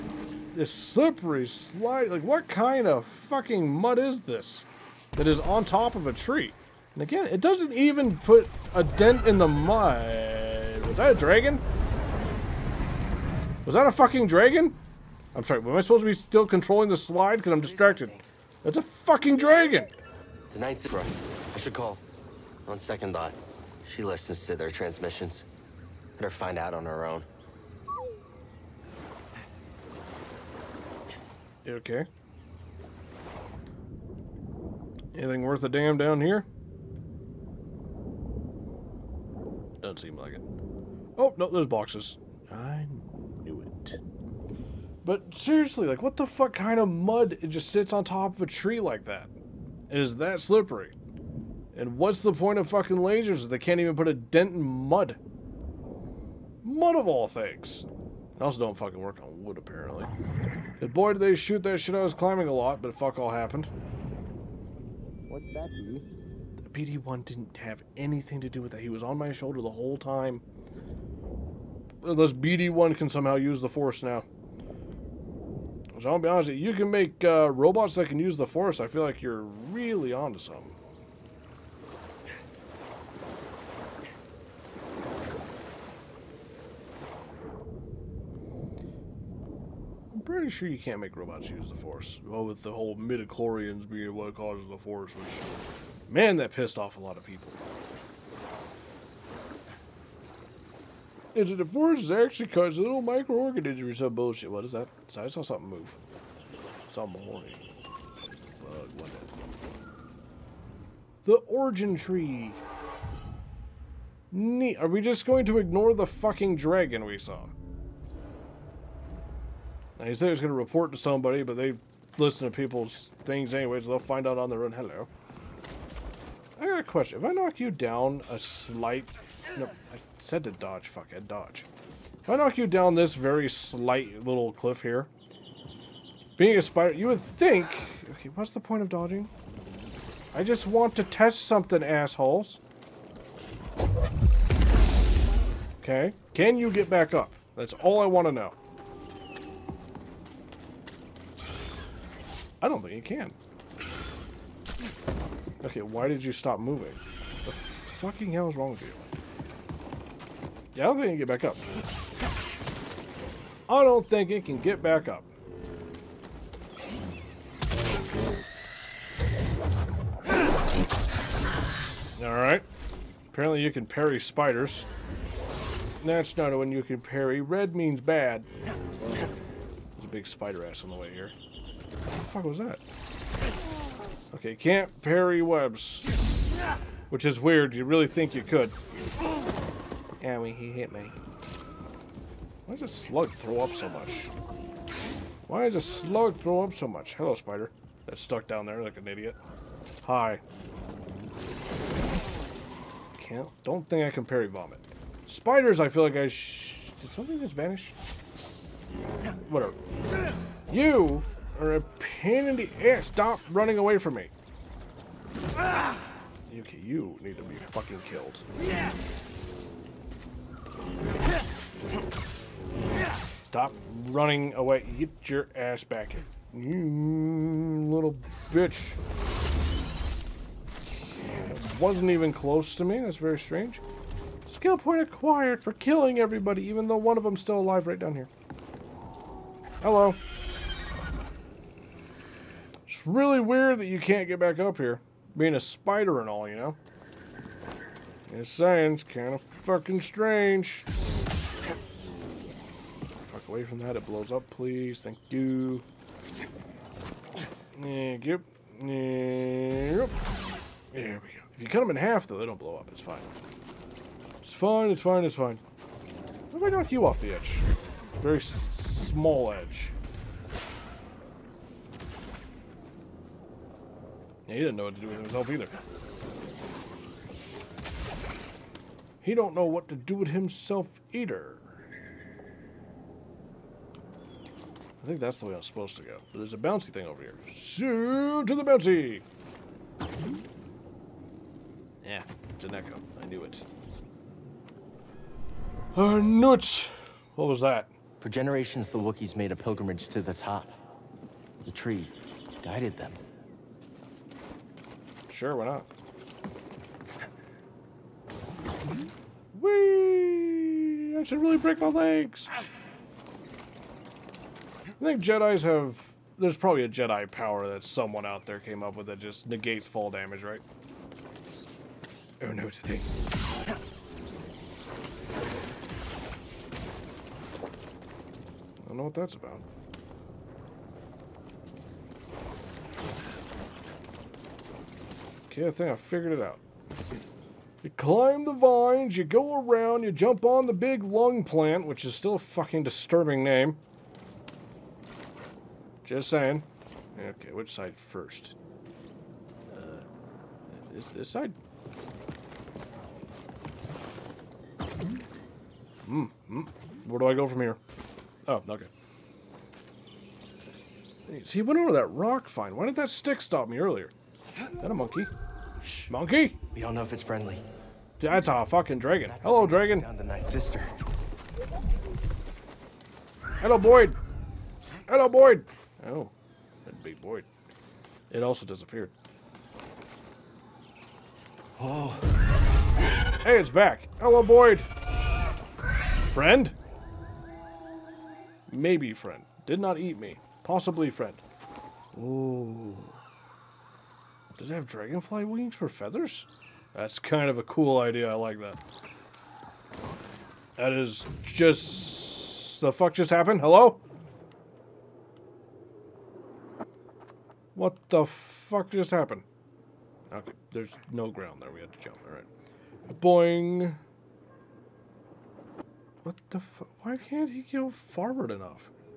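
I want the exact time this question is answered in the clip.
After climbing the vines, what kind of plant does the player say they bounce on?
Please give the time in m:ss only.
5:40.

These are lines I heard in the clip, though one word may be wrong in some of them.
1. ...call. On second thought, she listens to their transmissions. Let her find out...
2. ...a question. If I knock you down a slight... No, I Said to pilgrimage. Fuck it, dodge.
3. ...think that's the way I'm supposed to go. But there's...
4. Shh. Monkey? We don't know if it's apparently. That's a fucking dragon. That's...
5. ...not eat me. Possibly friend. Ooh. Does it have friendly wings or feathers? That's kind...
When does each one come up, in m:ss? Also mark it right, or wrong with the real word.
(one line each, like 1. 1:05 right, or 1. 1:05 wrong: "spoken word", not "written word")
1. 0:21 right
2. 2:06 wrong: "dodge", not "pilgrimage"
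3. 4:45 right
4. 6:05 wrong: "friendly", not "apparently"
5. 6:29 wrong: "dragonfly", not "friendly".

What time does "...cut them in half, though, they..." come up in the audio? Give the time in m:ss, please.
4:21.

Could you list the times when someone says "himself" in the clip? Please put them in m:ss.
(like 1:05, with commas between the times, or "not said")
4:35, 4:40.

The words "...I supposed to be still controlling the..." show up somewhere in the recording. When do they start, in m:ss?
0:15.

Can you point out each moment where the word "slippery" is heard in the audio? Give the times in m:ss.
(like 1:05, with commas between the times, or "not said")
0:00, 0:50.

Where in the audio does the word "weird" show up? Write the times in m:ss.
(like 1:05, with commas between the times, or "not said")
3:07, 4:03.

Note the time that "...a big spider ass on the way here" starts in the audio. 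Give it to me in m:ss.
3:00.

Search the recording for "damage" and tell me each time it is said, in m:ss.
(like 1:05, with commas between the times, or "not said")
5:20.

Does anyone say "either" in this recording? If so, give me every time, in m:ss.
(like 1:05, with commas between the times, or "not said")
4:35, 4:41.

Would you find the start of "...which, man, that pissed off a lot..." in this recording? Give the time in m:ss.
1:35.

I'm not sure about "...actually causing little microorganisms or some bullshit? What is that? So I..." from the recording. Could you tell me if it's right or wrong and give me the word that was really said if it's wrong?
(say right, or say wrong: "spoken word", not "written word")
right.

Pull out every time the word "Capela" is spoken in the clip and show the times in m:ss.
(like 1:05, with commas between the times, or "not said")
not said.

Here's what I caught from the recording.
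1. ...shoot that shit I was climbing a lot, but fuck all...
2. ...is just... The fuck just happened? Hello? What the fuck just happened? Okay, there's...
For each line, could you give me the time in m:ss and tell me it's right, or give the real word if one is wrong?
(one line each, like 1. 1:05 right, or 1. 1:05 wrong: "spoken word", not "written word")
1. 1:01 right
2. 6:40 right.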